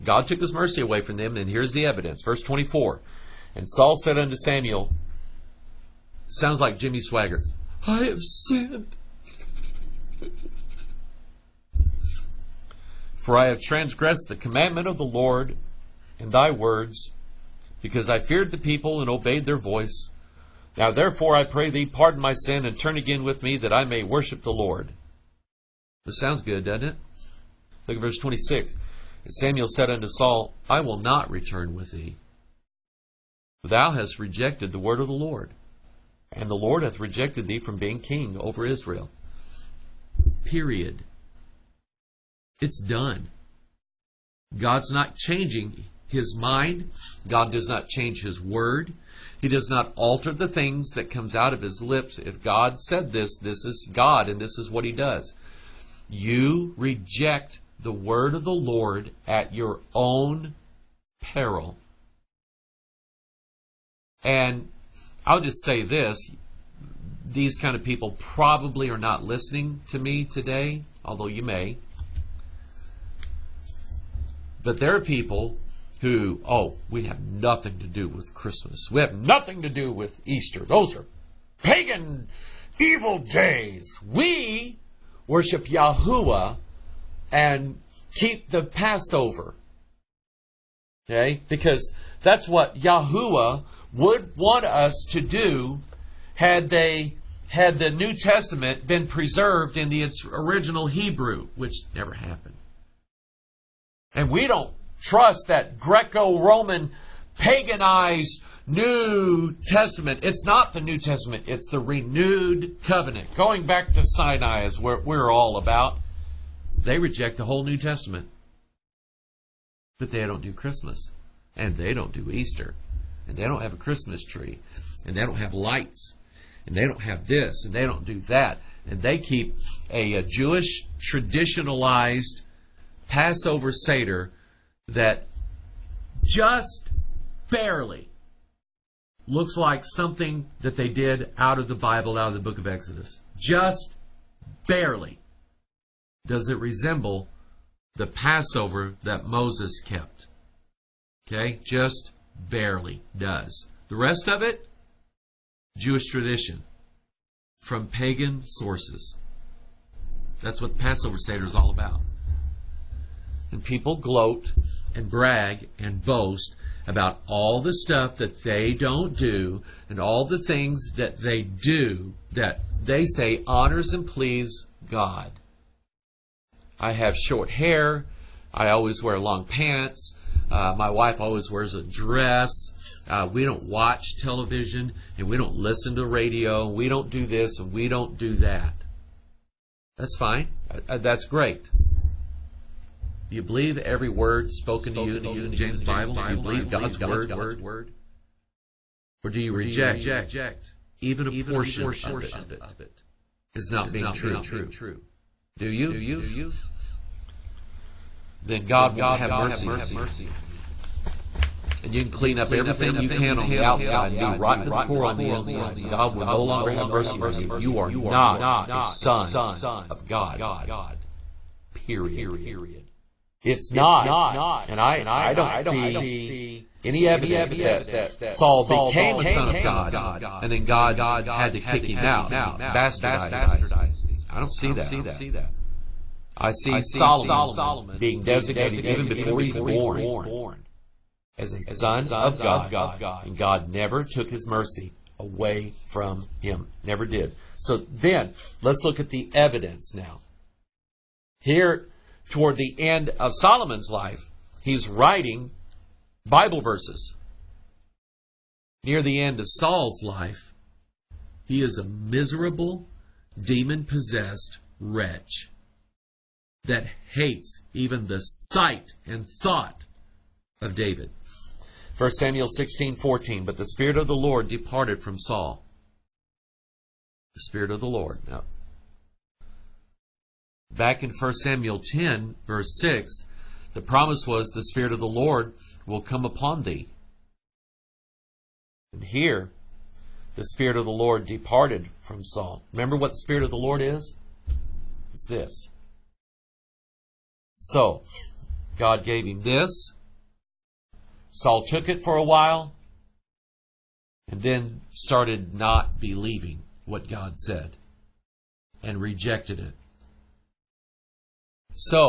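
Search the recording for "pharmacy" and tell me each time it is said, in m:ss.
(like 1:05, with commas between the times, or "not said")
not said.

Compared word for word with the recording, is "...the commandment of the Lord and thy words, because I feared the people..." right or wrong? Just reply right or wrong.
right.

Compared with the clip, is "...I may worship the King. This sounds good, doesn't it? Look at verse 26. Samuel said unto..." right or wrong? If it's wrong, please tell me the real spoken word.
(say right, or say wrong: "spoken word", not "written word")
wrong: "Lord", not "King".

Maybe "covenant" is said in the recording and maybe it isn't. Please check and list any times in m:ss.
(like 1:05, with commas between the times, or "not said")
1:52.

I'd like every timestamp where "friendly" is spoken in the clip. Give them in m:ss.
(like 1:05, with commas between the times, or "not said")
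not said.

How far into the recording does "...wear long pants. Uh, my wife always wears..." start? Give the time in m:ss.
2:59.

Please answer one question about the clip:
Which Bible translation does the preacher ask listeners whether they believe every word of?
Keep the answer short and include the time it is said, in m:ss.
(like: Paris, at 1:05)
King James Bible, at 3:15.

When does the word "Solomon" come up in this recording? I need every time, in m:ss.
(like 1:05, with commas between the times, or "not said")
3:56, 4:13.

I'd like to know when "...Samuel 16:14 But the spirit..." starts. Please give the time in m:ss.
4:32.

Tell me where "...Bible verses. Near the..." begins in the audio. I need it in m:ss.
4:16.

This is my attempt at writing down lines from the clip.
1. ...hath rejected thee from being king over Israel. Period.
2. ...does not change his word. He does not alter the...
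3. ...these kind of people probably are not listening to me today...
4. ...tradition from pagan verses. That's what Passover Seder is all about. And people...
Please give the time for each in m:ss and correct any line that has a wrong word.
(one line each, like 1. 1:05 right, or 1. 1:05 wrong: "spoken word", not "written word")
1. 0:36 right
2. 0:47 right
3. 1:07 right
4. 2:36 wrong: "sources", not "verses".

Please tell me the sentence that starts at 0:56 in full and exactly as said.
You reject the word of the Lord at your own peril.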